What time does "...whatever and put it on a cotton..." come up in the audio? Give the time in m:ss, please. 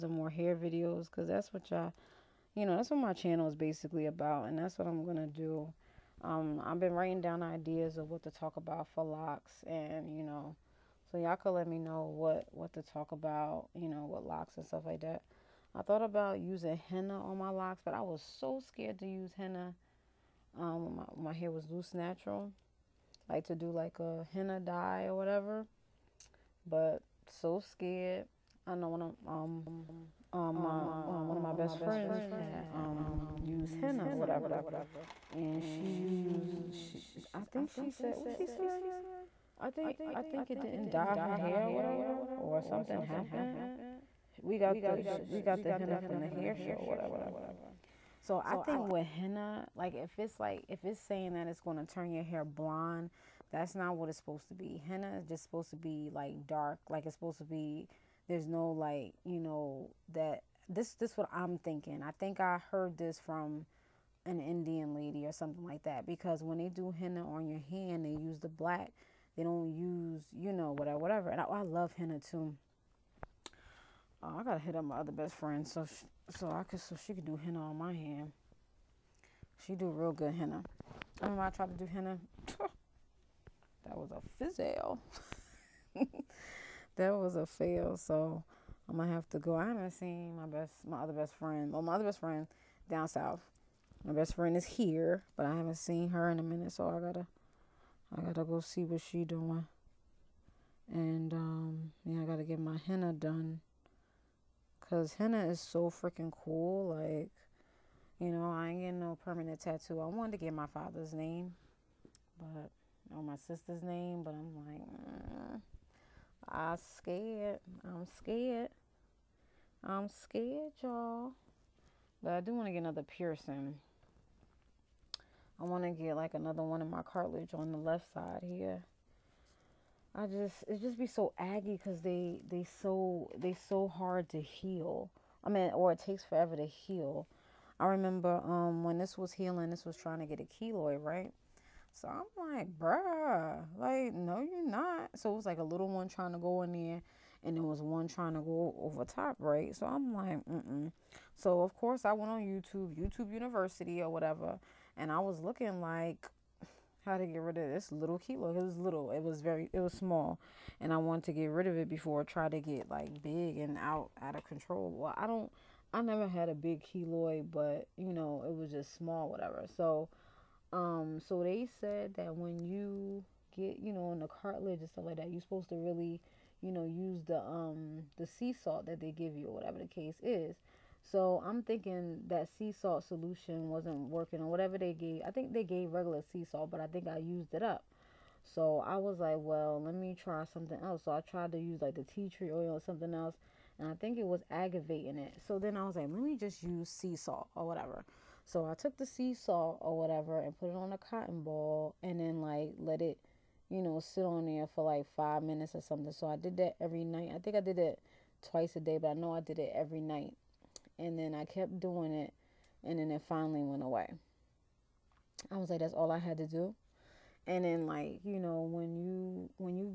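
3:19.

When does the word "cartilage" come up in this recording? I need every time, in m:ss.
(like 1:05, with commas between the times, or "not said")
2:07, 2:54.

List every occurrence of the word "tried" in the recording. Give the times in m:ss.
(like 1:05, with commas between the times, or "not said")
1:21, 3:11.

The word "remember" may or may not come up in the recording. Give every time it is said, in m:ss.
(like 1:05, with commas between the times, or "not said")
1:21, 2:17.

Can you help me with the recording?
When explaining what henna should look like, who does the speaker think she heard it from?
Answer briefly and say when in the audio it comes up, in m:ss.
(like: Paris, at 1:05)
an Indian lady, at 1:04.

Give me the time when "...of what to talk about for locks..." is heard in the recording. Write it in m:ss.
0:07.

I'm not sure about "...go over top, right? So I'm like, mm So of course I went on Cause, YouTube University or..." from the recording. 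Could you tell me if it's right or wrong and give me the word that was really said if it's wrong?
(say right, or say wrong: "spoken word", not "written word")
wrong: "YouTube", not "Cause".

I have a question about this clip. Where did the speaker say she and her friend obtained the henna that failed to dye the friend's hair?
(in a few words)
the hair show.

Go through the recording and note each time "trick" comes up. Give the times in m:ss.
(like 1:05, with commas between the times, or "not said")
not said.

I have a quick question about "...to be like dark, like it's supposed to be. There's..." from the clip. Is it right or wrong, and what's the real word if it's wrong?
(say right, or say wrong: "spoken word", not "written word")
right.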